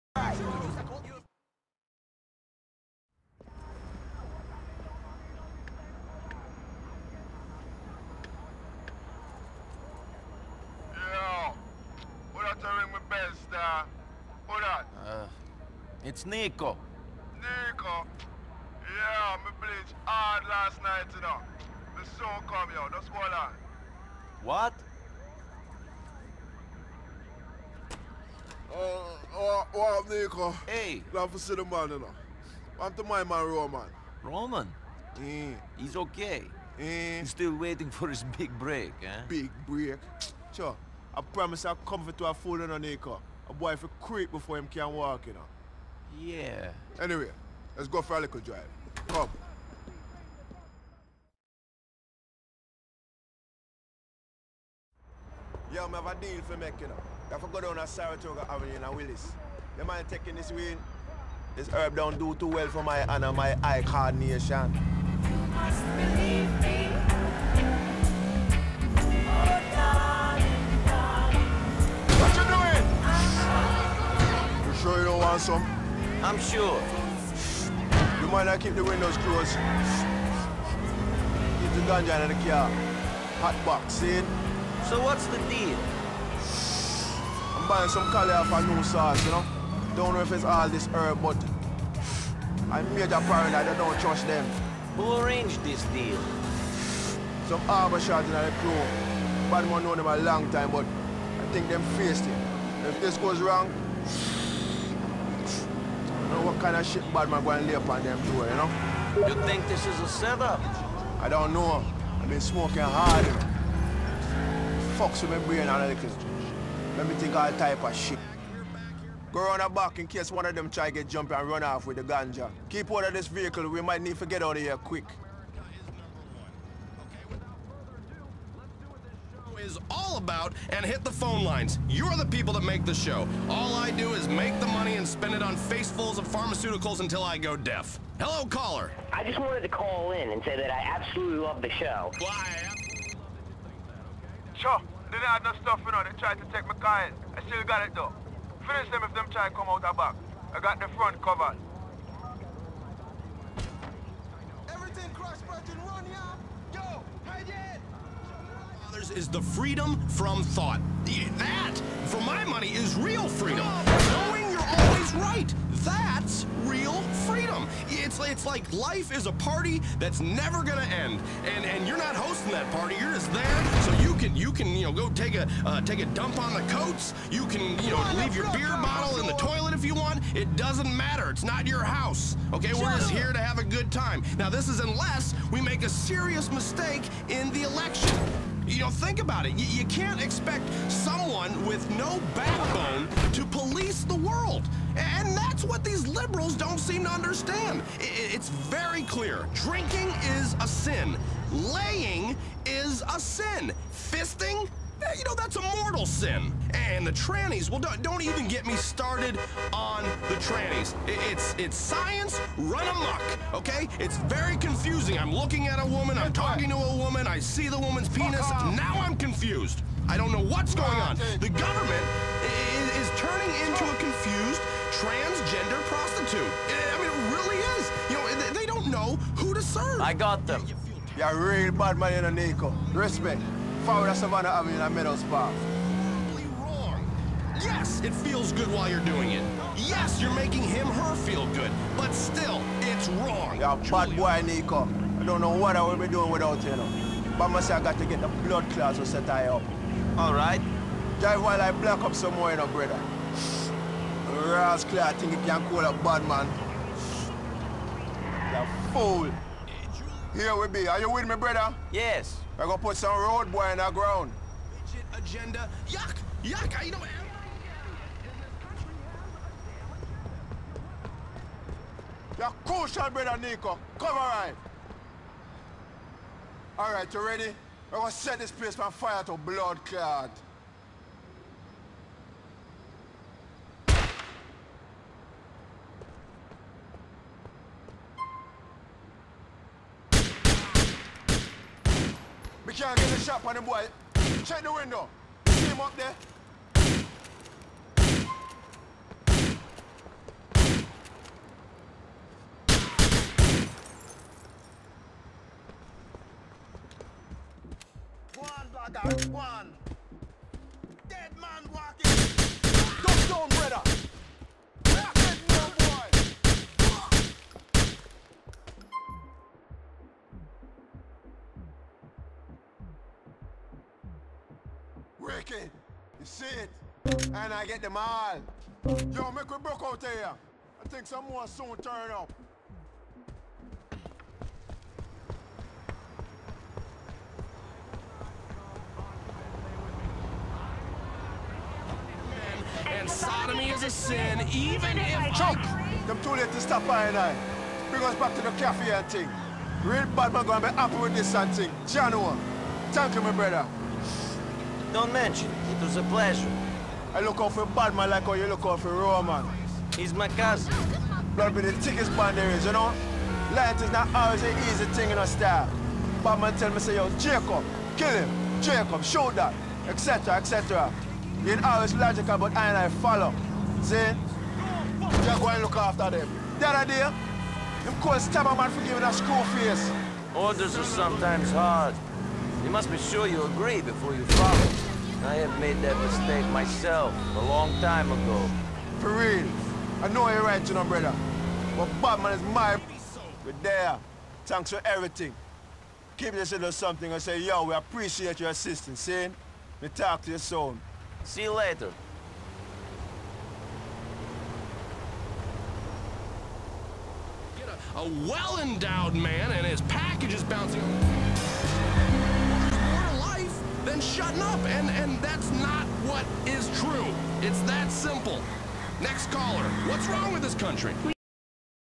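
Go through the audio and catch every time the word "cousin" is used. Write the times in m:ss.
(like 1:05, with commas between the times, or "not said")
6:00.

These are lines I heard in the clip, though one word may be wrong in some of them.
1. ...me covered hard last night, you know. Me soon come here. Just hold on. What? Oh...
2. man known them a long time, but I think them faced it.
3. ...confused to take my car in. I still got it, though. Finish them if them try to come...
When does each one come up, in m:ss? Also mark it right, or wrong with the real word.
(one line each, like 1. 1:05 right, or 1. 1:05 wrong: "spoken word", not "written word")
1. 0:19 wrong: "bleached", not "covered"
2. 1:39 right
3. 2:26 wrong: "tried", not "confused".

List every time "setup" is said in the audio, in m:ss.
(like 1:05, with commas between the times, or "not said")
1:50.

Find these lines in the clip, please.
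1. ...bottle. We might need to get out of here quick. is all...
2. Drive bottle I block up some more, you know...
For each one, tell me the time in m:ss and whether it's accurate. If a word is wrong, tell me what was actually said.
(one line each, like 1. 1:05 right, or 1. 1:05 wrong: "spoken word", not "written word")
1. 2:03 wrong: "vehicle", not "bottle"
2. 4:11 wrong: "while", not "bottle".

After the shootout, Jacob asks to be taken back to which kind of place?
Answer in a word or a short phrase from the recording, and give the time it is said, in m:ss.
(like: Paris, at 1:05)
The cafe, at 5:48.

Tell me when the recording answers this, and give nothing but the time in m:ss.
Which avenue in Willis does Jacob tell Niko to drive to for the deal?
0:57.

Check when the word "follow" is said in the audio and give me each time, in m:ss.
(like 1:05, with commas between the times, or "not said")
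6:12, 6:24.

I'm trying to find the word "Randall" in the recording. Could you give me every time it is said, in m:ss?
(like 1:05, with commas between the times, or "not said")
not said.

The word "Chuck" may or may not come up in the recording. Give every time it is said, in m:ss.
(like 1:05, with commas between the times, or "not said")
5:45.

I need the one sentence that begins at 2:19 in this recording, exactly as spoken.
I just wanted to call in and say that I absolutely love the show.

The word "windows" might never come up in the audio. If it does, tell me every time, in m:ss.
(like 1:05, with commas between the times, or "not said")
1:18, 4:54.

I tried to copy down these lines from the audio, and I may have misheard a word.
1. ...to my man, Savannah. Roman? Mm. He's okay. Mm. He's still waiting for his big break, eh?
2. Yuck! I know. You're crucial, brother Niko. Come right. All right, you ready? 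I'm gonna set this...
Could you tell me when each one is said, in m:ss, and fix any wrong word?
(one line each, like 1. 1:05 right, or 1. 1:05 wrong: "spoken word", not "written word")
1. 0:32 wrong: "Roman", not "Savannah"
2. 4:26 right.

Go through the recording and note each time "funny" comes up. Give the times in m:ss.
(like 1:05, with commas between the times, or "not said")
not said.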